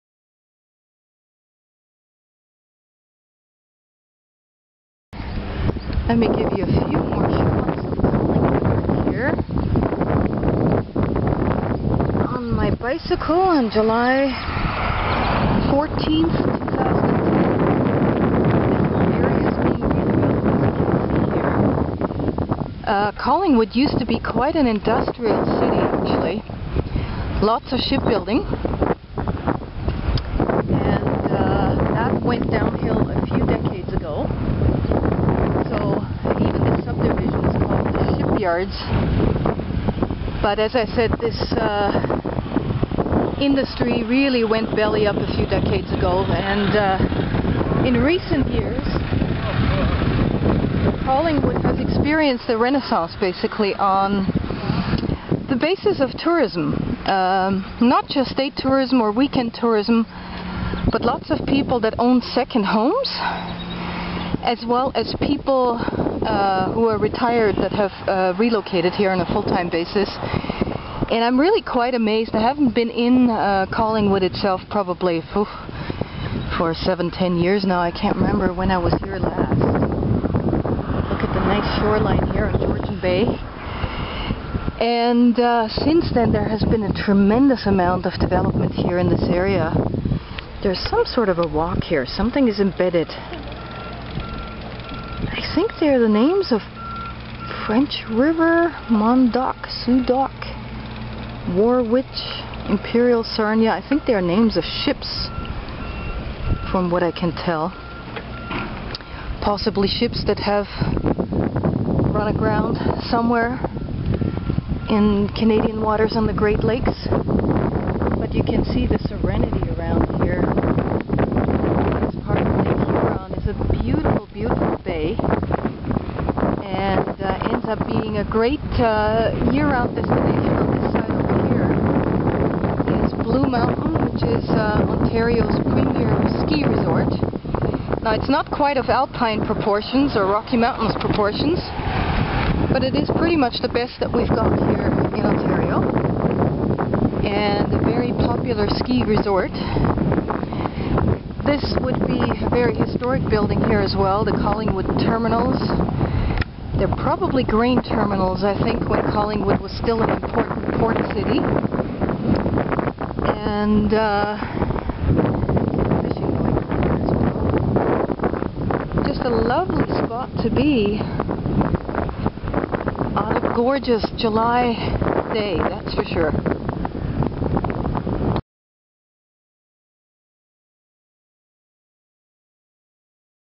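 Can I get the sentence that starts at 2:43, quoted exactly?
And, uh, Just a lovely spot to be on a gorgeous July day, that's for sure.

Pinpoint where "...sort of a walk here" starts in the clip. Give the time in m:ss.
1:31.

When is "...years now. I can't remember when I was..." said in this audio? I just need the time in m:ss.
1:17.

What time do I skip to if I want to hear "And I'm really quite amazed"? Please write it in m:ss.
1:11.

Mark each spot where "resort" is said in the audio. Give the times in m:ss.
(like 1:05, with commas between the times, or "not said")
2:16, 2:29.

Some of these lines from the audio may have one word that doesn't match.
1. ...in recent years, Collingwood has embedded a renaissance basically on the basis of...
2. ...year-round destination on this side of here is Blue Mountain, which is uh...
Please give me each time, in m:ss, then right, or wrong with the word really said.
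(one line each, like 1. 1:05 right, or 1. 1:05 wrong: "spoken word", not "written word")
1. 0:47 wrong: "experienced", not "embedded"
2. 2:09 right.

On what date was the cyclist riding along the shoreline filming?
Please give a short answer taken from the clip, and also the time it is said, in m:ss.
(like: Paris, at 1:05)
July 14th, 2010, at 0:13.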